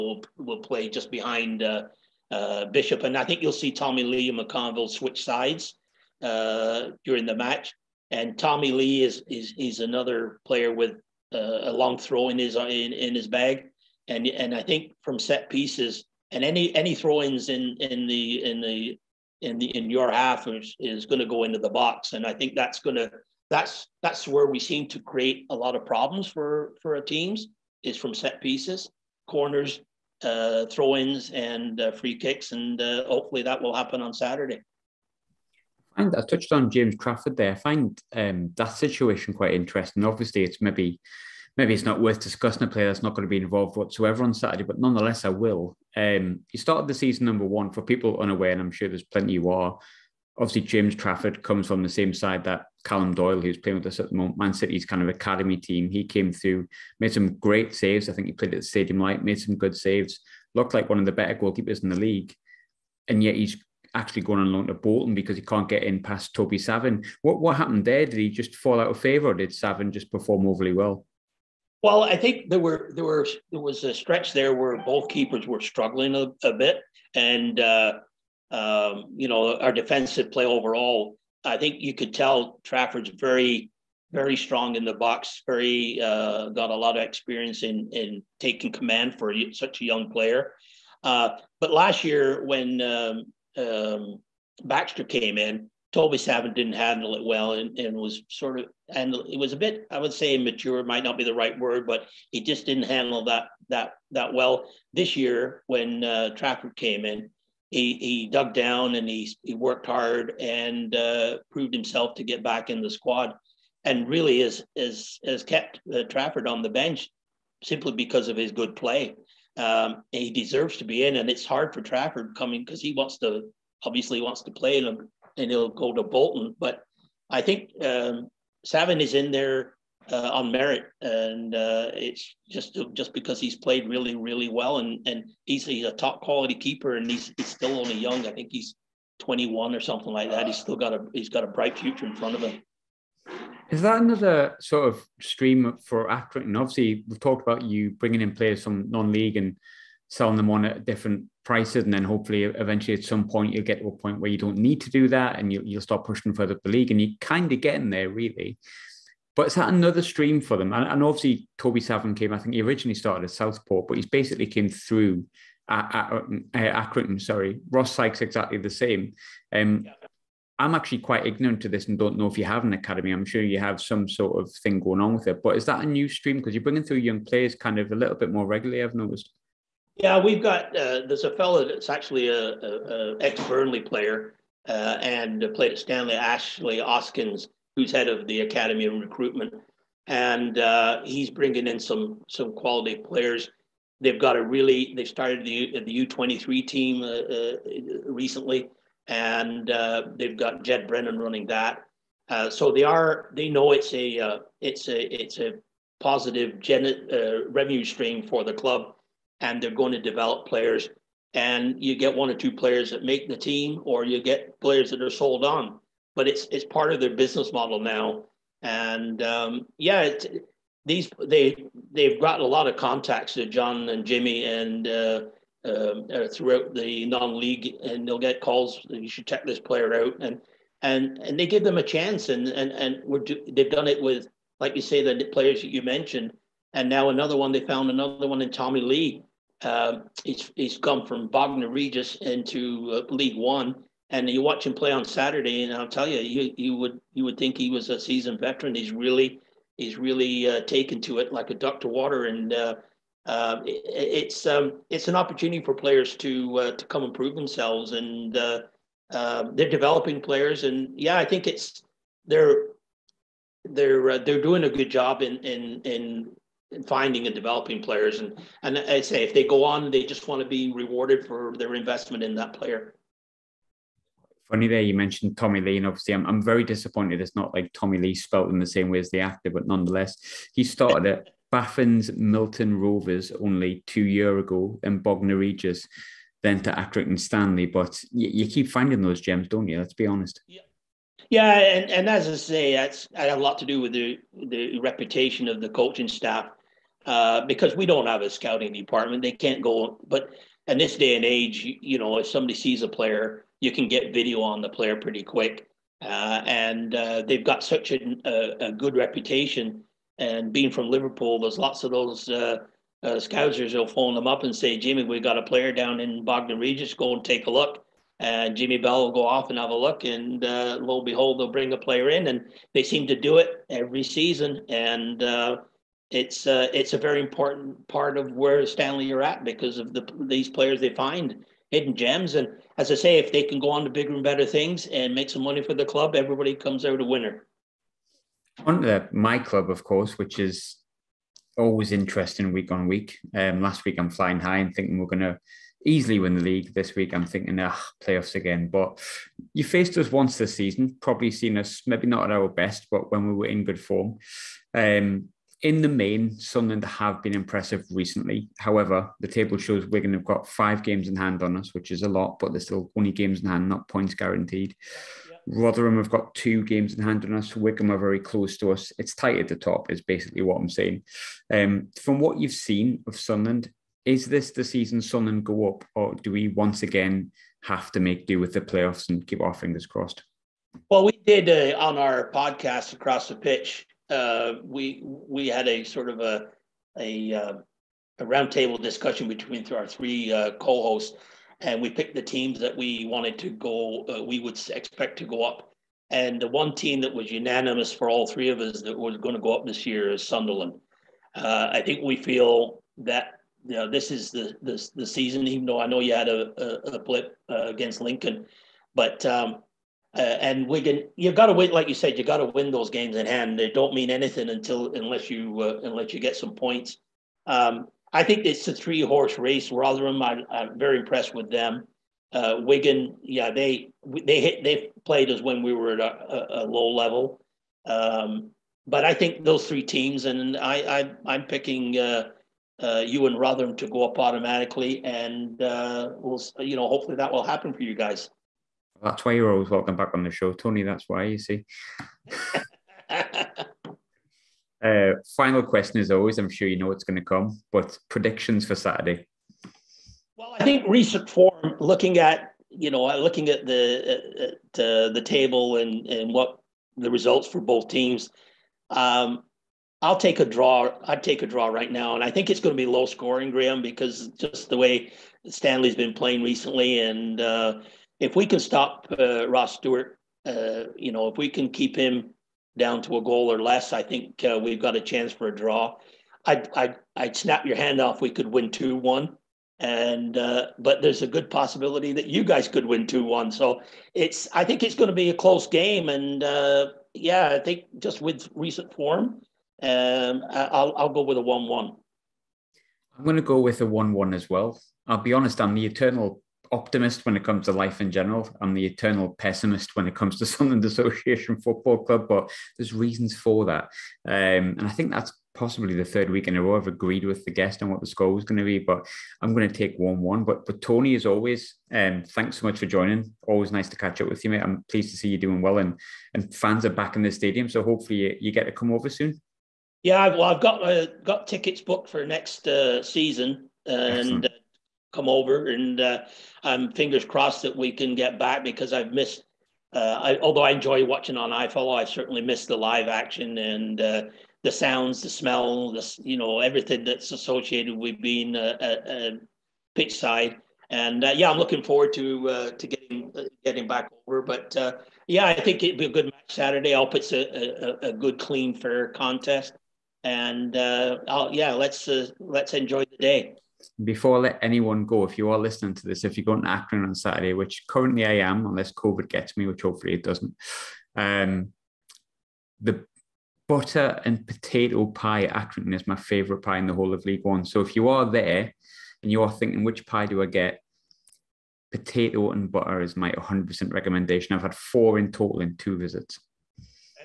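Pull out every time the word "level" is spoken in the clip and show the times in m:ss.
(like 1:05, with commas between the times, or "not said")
7:06.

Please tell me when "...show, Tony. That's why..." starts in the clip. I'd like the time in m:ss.
7:20.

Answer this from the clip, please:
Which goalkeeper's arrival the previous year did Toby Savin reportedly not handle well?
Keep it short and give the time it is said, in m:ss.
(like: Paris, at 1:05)
Baxter, at 1:34.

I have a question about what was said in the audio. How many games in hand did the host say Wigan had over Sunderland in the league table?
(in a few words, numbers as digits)
5.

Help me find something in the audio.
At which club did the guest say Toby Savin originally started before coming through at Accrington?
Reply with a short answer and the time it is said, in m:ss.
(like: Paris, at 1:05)
Southport, at 2:43.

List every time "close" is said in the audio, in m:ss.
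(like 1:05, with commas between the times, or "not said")
6:08, 8:05.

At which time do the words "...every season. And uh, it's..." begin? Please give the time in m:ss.
5:23.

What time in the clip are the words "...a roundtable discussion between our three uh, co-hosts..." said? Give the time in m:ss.
6:28.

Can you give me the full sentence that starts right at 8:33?
Always nice to catch up with you, mate.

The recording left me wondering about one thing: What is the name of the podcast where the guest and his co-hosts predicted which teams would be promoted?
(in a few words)
Across the Pitch.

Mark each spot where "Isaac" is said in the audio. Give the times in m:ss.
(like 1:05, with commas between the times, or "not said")
not said.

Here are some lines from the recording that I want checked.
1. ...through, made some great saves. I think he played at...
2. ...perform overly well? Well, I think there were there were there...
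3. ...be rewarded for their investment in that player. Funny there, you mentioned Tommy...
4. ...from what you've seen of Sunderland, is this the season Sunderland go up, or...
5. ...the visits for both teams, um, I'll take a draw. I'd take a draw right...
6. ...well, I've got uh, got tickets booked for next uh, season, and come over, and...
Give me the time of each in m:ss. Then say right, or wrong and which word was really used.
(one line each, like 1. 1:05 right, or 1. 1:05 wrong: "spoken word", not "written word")
1. 0:56 right
2. 1:10 right
3. 4:30 right
4. 6:12 right
5. 7:36 wrong: "results", not "visits"
6. 8:40 right.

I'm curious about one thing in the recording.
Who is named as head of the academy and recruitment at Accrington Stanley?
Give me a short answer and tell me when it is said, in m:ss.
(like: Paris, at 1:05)
Ashley Hoskins, at 3:06.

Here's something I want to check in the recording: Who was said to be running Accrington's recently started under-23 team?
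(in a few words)
Jed Brennan.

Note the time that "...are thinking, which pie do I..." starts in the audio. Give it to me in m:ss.
9:29.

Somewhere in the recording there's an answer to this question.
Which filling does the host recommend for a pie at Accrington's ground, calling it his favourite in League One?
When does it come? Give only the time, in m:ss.
9:23.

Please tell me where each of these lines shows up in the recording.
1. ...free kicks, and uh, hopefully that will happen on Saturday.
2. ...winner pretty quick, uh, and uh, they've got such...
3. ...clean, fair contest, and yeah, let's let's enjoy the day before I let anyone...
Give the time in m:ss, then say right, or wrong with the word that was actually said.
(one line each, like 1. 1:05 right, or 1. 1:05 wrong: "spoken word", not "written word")
1. 0:31 right
2. 5:04 wrong: "player", not "winner"
3. 9:08 right.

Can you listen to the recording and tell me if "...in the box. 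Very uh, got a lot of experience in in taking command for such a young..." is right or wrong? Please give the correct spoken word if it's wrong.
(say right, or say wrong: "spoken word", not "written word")
right.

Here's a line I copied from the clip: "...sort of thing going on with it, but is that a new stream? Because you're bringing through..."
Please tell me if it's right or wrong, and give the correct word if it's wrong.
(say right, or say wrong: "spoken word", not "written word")
right.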